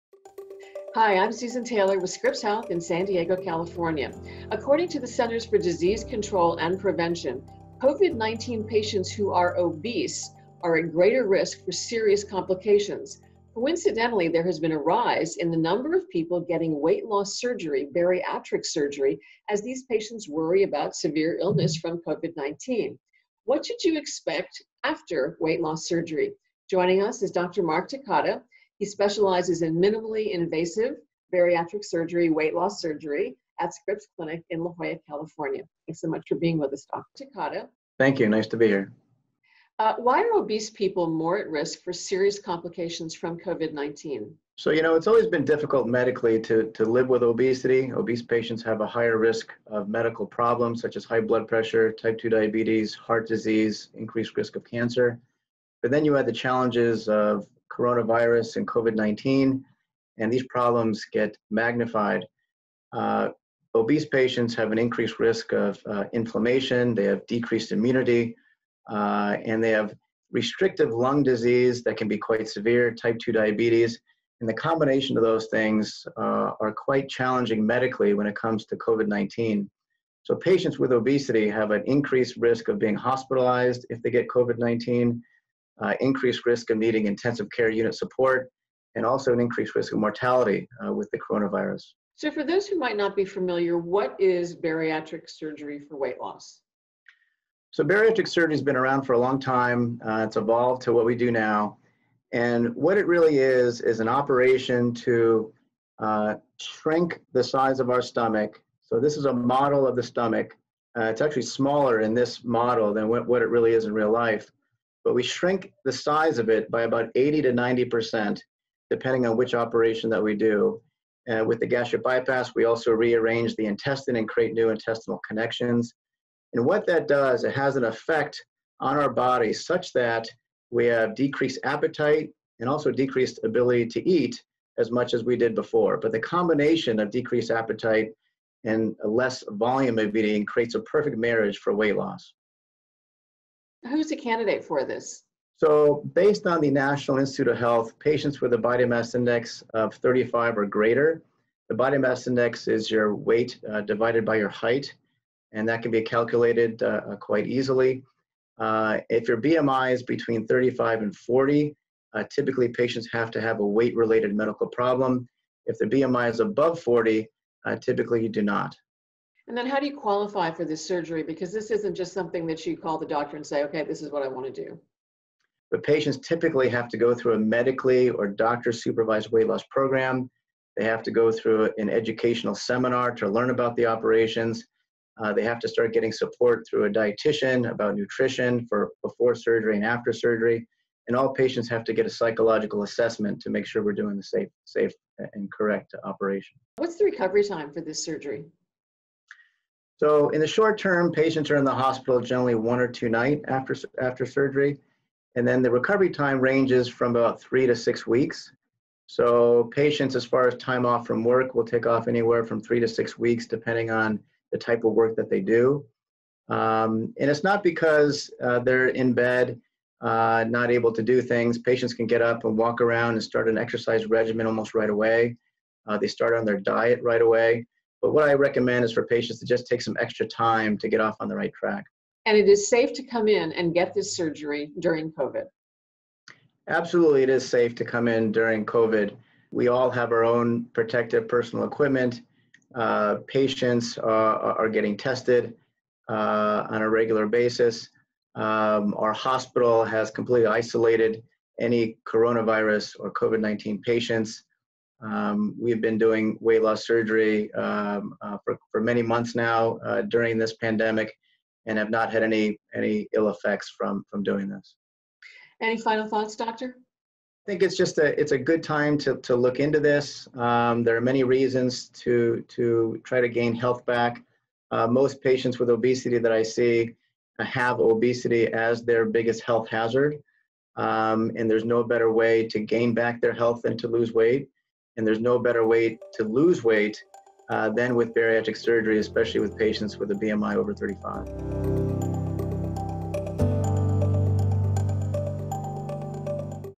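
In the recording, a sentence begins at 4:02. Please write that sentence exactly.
Uh, patients uh, are getting tested uh, on a regular basis.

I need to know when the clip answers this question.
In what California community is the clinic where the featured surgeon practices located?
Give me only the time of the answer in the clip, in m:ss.
0:34.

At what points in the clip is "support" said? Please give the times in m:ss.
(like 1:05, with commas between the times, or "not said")
1:27, 3:06.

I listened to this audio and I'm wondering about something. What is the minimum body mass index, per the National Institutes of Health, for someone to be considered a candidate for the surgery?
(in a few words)
35.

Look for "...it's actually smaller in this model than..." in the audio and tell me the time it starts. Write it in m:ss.
1:51.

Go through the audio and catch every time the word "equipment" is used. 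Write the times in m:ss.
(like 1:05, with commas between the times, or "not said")
4:01.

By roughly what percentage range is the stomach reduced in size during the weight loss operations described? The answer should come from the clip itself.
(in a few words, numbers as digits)
80 to 90%.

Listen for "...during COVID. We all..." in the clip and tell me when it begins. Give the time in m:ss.
3:58.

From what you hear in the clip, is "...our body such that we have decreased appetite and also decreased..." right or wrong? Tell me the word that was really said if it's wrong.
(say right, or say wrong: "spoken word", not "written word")
right.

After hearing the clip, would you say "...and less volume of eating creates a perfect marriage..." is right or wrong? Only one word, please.
right.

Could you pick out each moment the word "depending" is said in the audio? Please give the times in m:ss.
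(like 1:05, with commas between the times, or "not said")
1:58, 3:33.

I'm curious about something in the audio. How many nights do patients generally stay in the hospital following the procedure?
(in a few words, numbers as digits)
1 or 2.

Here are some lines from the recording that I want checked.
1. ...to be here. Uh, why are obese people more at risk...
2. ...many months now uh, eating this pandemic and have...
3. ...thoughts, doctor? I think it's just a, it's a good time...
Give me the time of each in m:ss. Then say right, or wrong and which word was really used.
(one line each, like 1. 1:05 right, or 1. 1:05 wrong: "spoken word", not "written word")
1. 0:38 right
2. 4:18 wrong: "during", not "eating"
3. 4:26 right.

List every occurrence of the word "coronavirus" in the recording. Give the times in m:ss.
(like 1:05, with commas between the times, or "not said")
0:57, 1:31, 4:12.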